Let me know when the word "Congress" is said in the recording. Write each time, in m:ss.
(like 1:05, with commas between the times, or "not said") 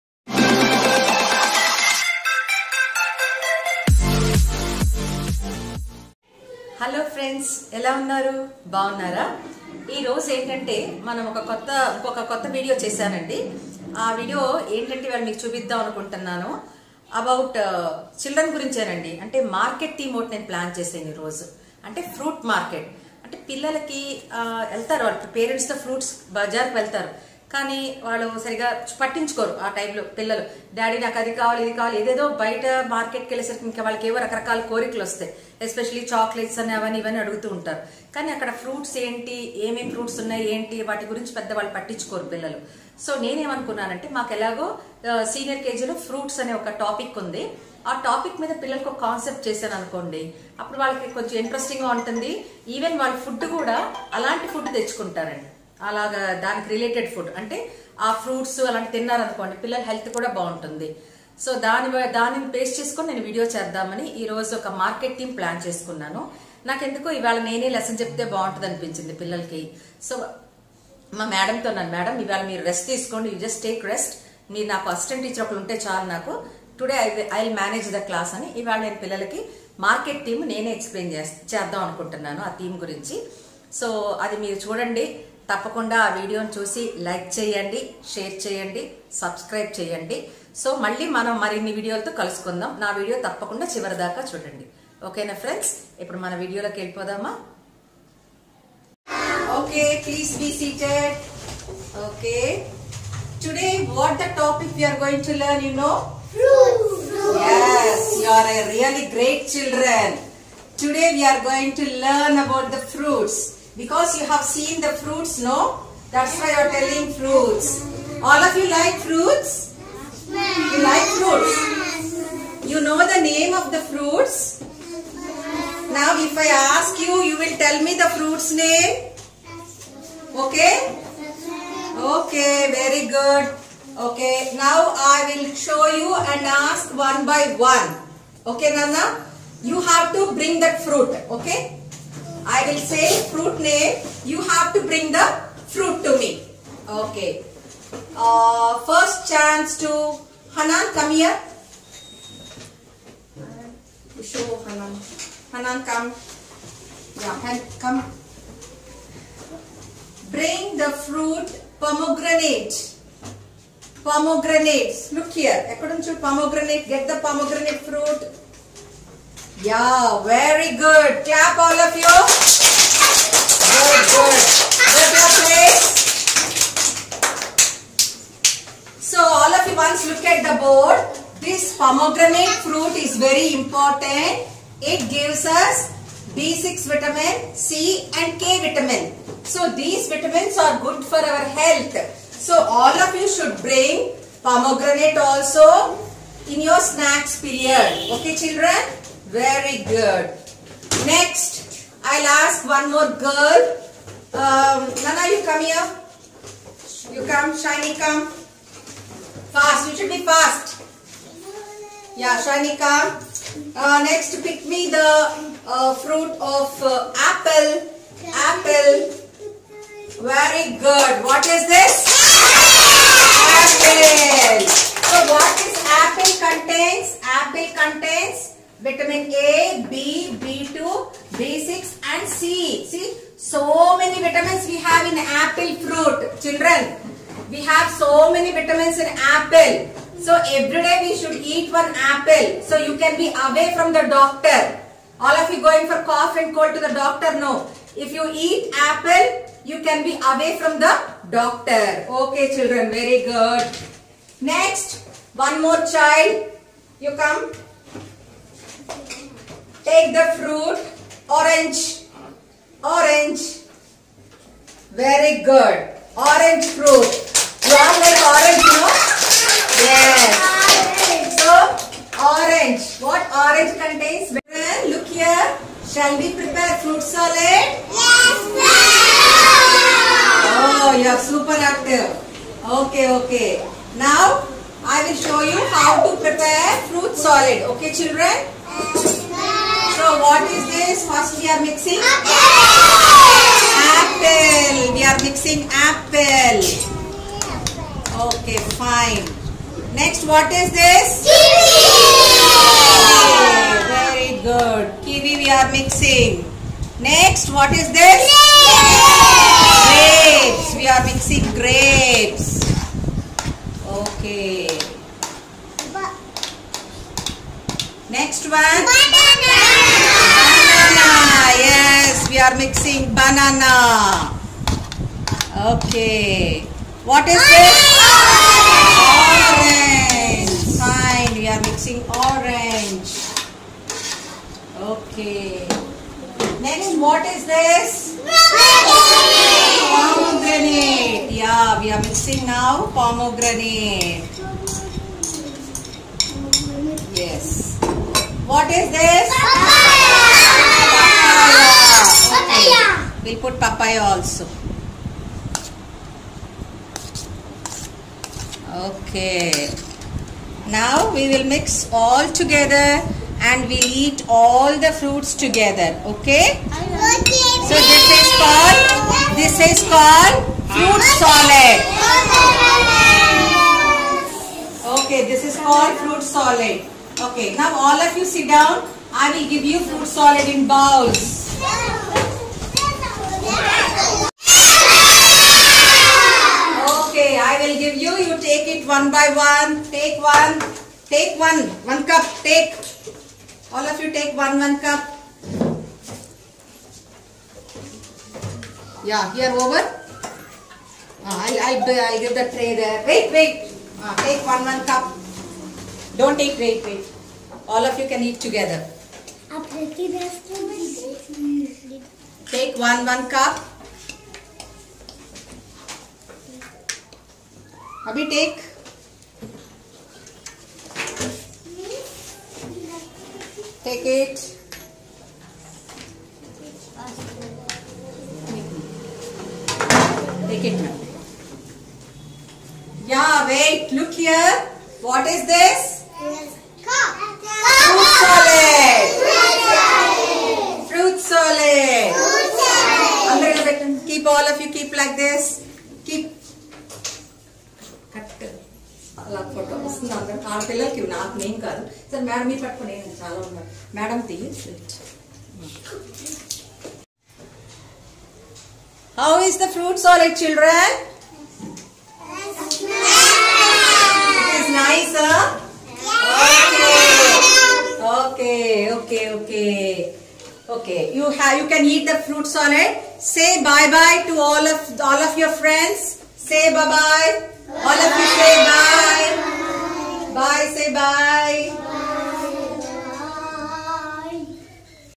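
not said.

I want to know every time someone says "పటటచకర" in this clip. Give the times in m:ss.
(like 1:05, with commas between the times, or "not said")
0:29, 0:41.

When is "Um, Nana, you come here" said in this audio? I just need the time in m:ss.
3:24.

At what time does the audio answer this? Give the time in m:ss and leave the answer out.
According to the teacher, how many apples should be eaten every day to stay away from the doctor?
4:01.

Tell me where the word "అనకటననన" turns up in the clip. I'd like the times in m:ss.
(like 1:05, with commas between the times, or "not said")
0:15, 1:21.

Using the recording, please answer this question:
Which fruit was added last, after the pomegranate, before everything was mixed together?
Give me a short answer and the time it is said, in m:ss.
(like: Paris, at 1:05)
Papaya, at 5:53.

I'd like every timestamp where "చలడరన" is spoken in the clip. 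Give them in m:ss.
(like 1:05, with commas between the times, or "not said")
0:18.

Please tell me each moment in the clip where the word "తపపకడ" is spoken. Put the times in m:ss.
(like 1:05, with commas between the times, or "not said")
1:25, 1:33.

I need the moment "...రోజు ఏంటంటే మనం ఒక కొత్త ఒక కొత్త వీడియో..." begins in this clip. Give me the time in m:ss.
0:10.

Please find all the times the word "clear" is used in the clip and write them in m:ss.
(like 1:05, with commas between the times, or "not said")
not said.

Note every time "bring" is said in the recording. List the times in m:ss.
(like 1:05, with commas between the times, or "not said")
2:20, 2:24, 2:40, 3:13.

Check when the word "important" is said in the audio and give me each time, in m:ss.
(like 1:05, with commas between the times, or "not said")
3:03.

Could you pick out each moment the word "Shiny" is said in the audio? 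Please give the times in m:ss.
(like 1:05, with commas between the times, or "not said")
3:27, 3:32.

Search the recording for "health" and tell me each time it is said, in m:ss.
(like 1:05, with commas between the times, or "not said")
3:11.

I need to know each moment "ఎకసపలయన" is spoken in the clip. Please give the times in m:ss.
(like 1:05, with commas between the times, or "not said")
1:20.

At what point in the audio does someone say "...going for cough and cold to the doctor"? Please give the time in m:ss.
4:05.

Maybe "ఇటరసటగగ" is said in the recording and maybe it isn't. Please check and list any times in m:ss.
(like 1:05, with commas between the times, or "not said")
0:51.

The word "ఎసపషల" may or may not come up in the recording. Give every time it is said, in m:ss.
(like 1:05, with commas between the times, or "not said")
0:35.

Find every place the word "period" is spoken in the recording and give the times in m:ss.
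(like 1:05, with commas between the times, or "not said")
3:17.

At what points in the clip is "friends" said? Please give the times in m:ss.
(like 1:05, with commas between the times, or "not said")
7:55.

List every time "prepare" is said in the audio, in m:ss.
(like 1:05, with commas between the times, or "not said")
4:36, 4:46.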